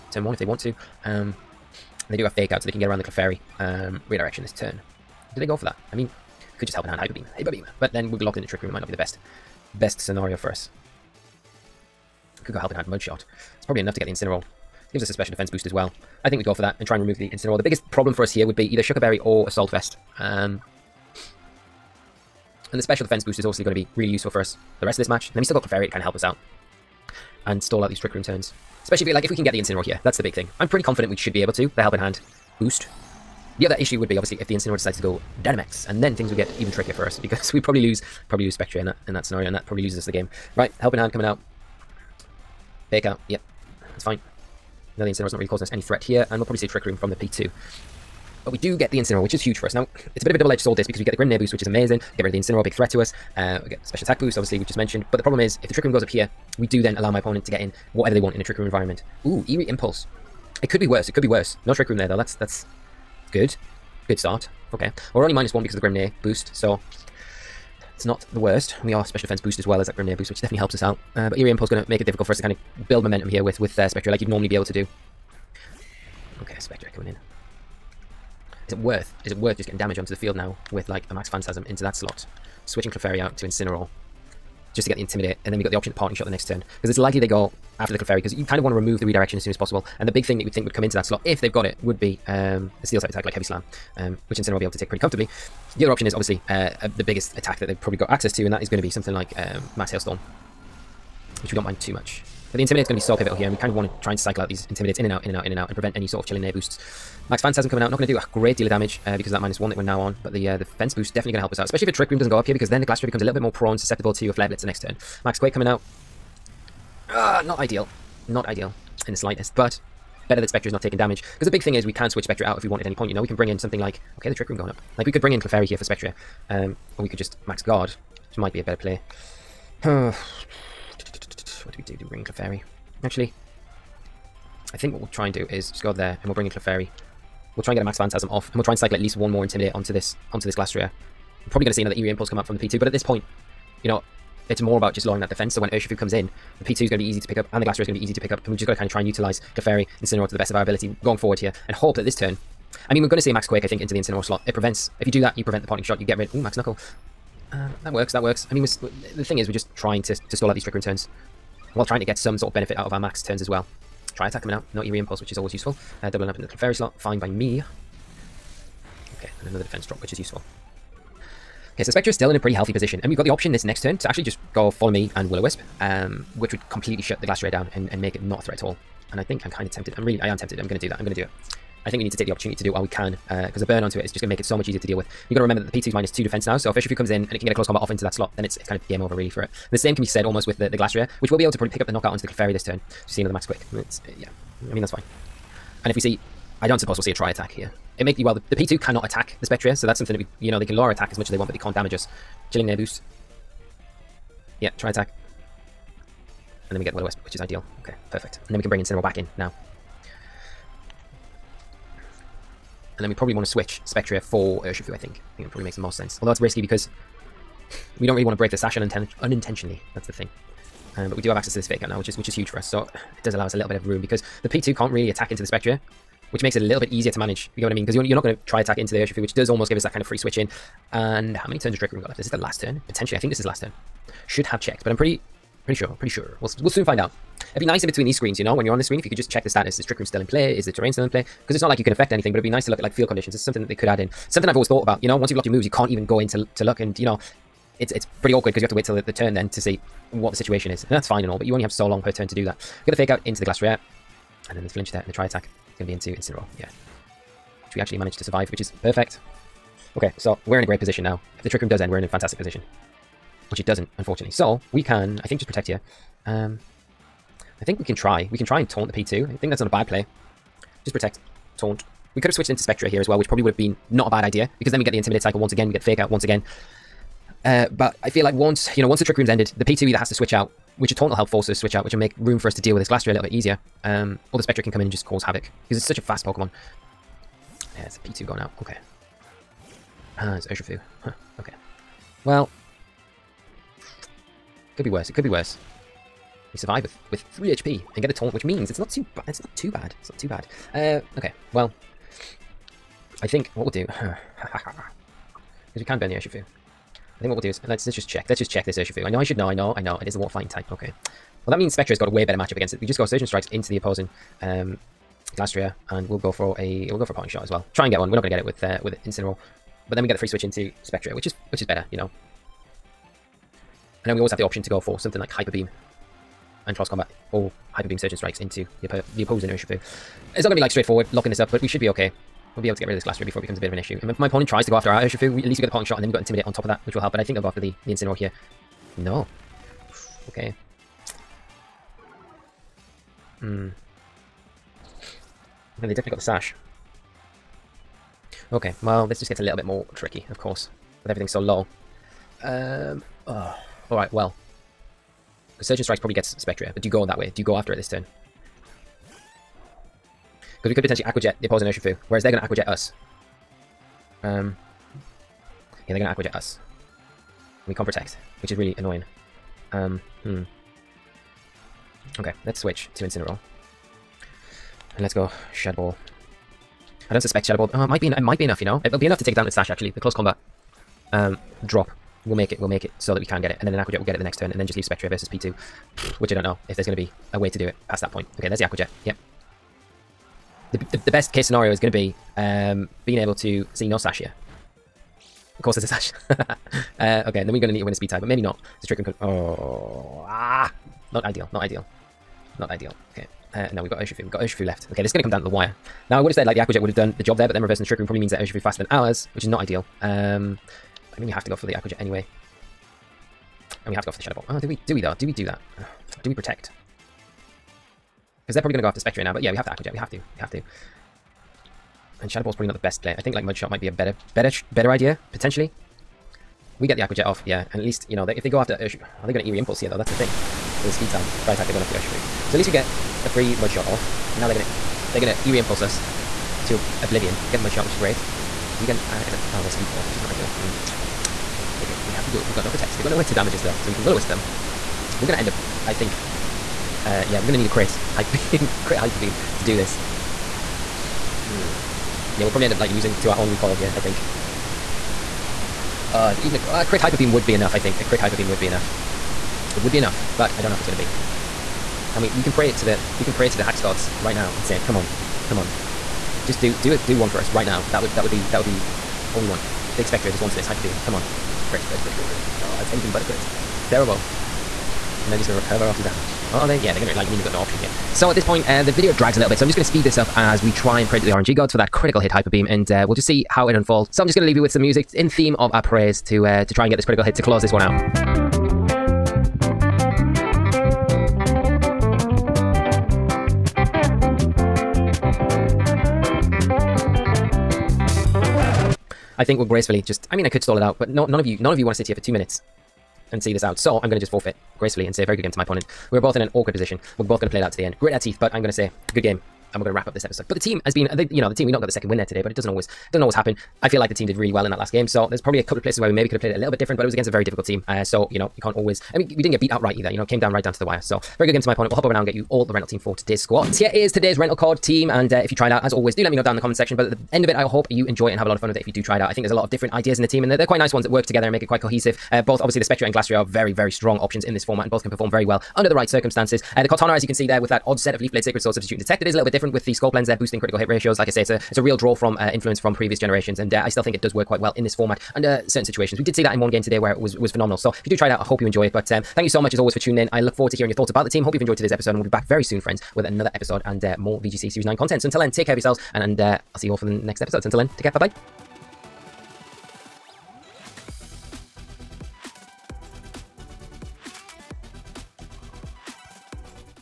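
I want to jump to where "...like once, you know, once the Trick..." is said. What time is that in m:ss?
4:38.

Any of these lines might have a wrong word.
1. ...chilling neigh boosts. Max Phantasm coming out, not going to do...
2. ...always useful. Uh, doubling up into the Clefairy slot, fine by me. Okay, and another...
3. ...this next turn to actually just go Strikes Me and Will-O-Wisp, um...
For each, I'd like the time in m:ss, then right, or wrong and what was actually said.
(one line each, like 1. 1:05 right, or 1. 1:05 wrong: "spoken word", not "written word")
1. 1:46 right
2. 2:45 right
3. 2:53 wrong: "Follow", not "Strikes".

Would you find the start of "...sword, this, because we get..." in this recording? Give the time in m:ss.
0:50.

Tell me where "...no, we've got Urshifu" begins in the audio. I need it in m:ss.
6:43.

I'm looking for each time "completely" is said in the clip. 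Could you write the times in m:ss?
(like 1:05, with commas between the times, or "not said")
2:56.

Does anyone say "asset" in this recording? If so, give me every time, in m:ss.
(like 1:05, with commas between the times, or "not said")
not said.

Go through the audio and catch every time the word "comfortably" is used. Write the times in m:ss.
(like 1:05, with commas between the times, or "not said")
1:34.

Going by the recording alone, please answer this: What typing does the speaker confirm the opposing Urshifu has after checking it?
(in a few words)
water fighting.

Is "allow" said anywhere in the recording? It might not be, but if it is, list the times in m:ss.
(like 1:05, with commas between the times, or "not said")
0:56, 3:43.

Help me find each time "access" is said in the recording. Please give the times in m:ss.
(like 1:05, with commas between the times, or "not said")
1:38, 3:41.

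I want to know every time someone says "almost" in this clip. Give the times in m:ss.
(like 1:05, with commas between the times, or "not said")
3:10, 3:49.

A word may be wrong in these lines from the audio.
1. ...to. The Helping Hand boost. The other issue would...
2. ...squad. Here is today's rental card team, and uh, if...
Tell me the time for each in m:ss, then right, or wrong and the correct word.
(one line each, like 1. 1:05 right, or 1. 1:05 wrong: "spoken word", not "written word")
1. 0:31 right
2. 8:43 right.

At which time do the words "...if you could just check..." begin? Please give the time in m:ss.
3:58.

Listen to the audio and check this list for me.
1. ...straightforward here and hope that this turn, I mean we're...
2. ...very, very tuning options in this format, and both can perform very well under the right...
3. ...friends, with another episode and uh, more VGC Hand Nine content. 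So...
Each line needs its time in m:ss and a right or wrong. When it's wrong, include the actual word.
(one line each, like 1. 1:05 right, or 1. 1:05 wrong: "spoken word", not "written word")
1. 2:31 wrong: "forward", not "straightforward"
2. 8:53 wrong: "strong", not "tuning"
3. 9:12 wrong: "Series", not "Hand".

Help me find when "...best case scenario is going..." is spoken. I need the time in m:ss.
6:31.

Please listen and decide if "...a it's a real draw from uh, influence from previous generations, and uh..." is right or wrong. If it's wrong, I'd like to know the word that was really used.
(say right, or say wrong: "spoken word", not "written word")
right.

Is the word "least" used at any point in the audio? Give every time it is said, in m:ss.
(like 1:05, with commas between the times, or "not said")
2:18, 5:35, 7:07, 7:12.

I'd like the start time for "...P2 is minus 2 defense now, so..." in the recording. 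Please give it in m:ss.
3:05.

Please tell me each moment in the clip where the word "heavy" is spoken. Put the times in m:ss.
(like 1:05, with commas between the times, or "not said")
1:33.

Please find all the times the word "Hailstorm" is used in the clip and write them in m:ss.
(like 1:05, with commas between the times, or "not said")
1:39.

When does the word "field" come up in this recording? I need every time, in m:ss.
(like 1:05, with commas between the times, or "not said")
1:20, 4:02.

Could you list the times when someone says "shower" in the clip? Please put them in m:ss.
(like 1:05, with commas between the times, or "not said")
not said.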